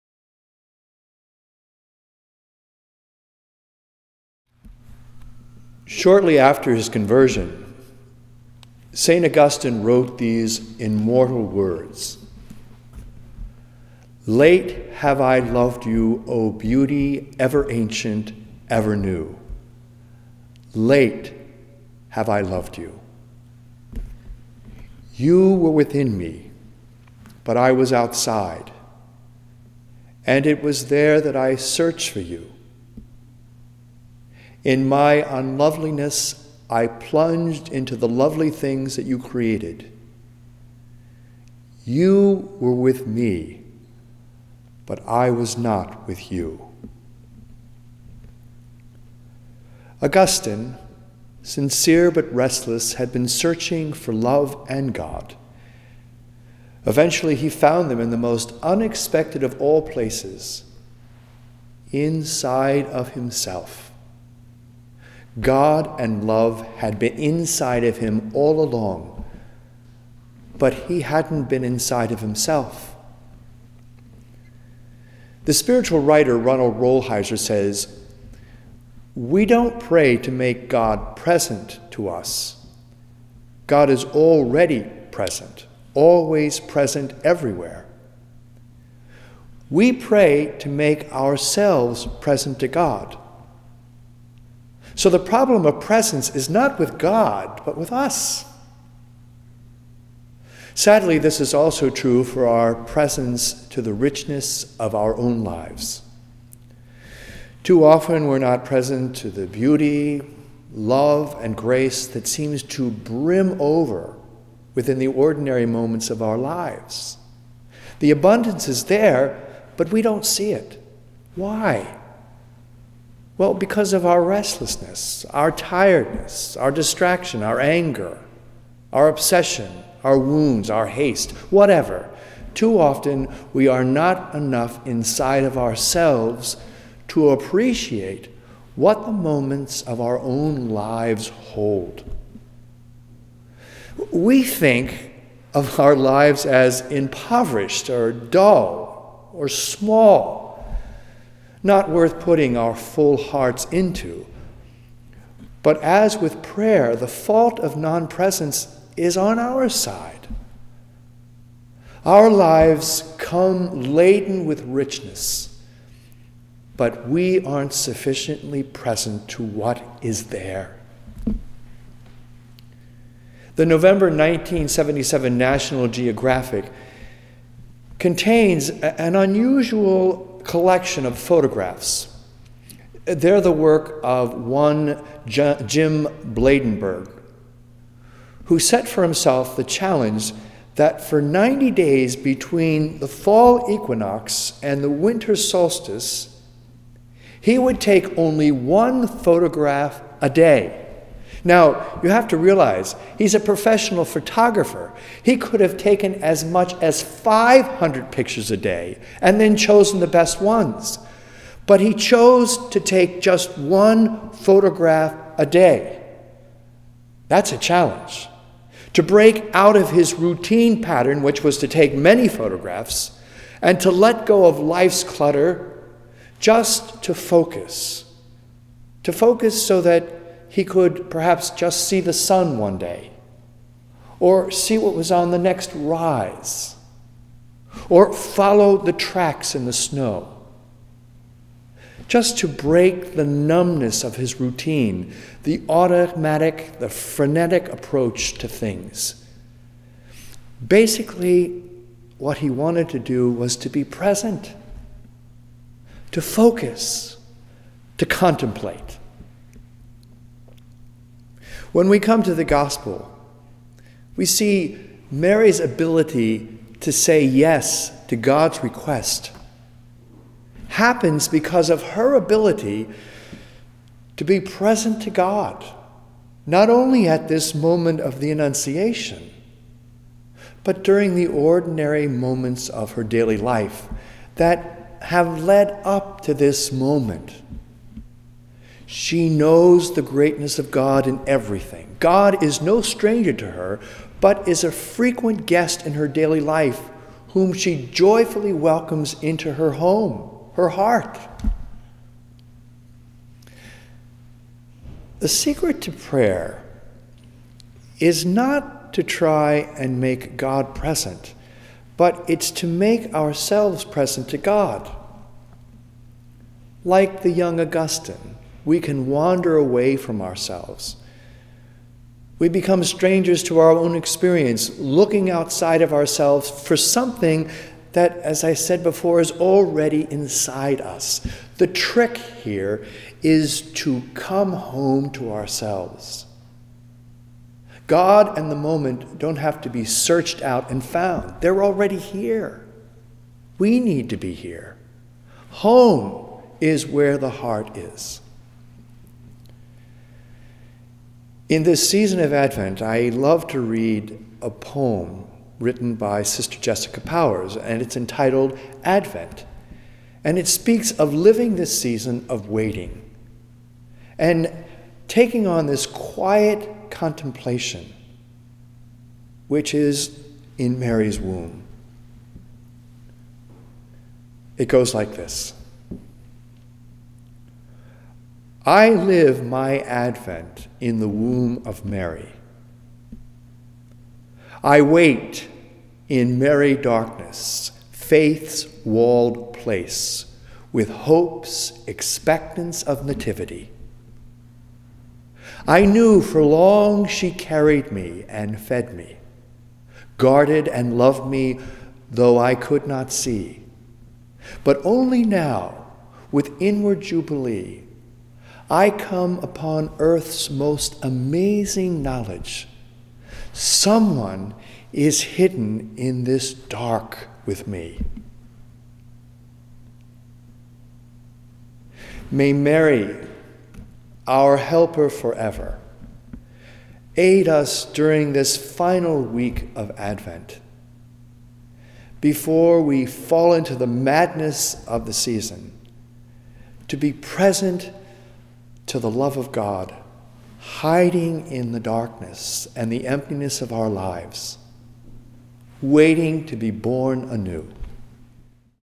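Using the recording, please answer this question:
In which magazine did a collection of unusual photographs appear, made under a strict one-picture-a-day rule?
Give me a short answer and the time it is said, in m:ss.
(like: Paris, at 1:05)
National Geographic, at 2:55.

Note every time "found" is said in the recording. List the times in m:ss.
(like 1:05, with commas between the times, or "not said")
0:57, 5:40.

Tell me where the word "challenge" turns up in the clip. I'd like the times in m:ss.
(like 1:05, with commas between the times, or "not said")
3:09, 3:37.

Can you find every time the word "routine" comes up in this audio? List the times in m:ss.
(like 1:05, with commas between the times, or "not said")
3:40, 4:04.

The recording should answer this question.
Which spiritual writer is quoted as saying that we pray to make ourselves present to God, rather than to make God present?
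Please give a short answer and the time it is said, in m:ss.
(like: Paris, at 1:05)
Ronald Rolheiser, at 1:16.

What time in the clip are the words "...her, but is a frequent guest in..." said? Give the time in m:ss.
4:53.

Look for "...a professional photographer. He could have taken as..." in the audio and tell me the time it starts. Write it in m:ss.
3:23.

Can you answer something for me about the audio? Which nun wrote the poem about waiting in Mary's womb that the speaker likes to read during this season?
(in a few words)
Sister Jessica Powers.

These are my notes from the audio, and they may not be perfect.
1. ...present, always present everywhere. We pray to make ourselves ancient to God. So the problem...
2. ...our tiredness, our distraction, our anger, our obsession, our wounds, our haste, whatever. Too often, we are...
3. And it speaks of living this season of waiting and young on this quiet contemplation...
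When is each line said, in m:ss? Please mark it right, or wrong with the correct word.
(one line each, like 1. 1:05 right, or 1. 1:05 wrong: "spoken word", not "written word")
1. 1:25 wrong: "present", not "ancient"
2. 2:05 right
3. 6:00 wrong: "taking", not "young".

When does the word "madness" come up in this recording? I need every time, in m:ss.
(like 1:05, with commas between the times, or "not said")
7:13.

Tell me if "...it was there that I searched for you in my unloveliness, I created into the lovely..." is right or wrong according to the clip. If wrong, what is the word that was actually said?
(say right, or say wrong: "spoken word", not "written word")
wrong: "plunged", not "created".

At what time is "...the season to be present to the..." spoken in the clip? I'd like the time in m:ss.
7:15.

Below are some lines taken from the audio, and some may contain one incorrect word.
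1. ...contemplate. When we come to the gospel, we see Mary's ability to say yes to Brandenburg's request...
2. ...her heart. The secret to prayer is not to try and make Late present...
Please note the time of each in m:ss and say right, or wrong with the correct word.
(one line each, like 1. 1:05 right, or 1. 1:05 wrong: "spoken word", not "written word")
1. 4:18 wrong: "God", not "Brandenburg"
2. 5:00 wrong: "God", not "Late".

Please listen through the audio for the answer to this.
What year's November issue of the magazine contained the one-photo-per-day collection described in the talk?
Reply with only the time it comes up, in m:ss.
2:54.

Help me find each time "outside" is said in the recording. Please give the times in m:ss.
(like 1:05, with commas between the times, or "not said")
0:27, 5:25.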